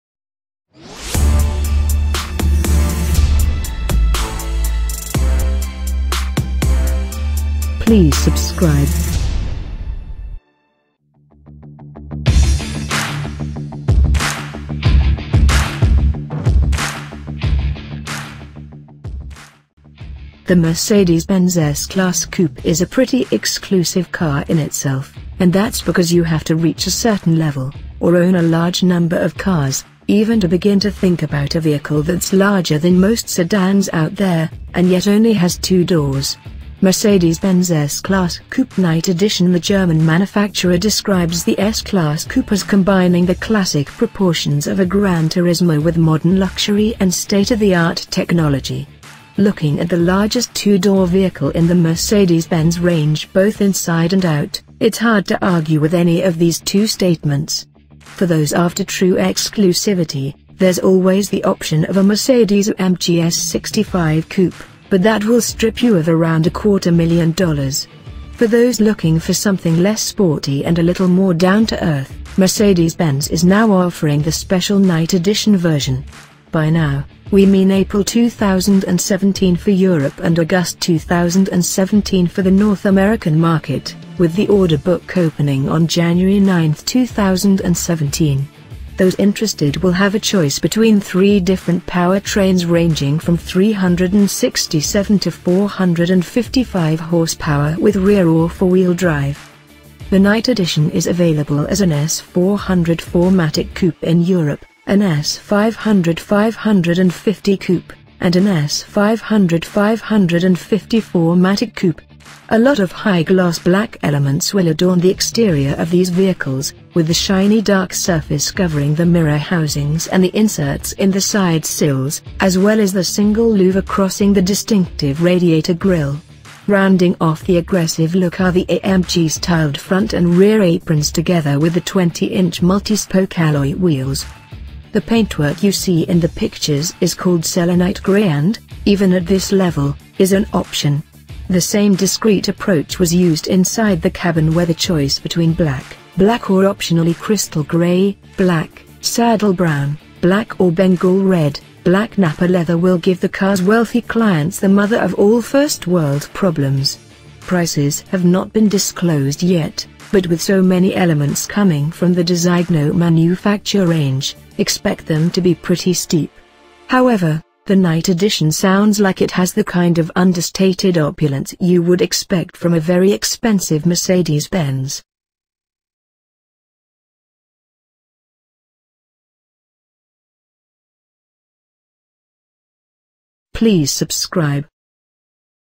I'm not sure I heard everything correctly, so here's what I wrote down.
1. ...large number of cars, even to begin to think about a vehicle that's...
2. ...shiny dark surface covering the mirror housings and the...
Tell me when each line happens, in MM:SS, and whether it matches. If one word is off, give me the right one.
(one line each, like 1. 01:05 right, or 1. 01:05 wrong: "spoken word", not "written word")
1. 00:28 right
2. 01:57 right.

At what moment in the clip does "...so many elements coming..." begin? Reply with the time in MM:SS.
02:40.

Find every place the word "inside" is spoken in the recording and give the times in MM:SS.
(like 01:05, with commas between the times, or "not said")
00:53, 02:23.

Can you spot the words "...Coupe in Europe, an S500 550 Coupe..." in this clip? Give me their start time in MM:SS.
01:43.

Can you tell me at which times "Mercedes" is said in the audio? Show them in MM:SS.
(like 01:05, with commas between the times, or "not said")
00:20, 00:36, 00:51, 01:02, 01:12, 02:53.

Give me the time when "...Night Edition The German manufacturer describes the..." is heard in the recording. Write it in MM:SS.
00:38.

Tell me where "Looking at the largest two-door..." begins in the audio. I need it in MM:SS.
00:49.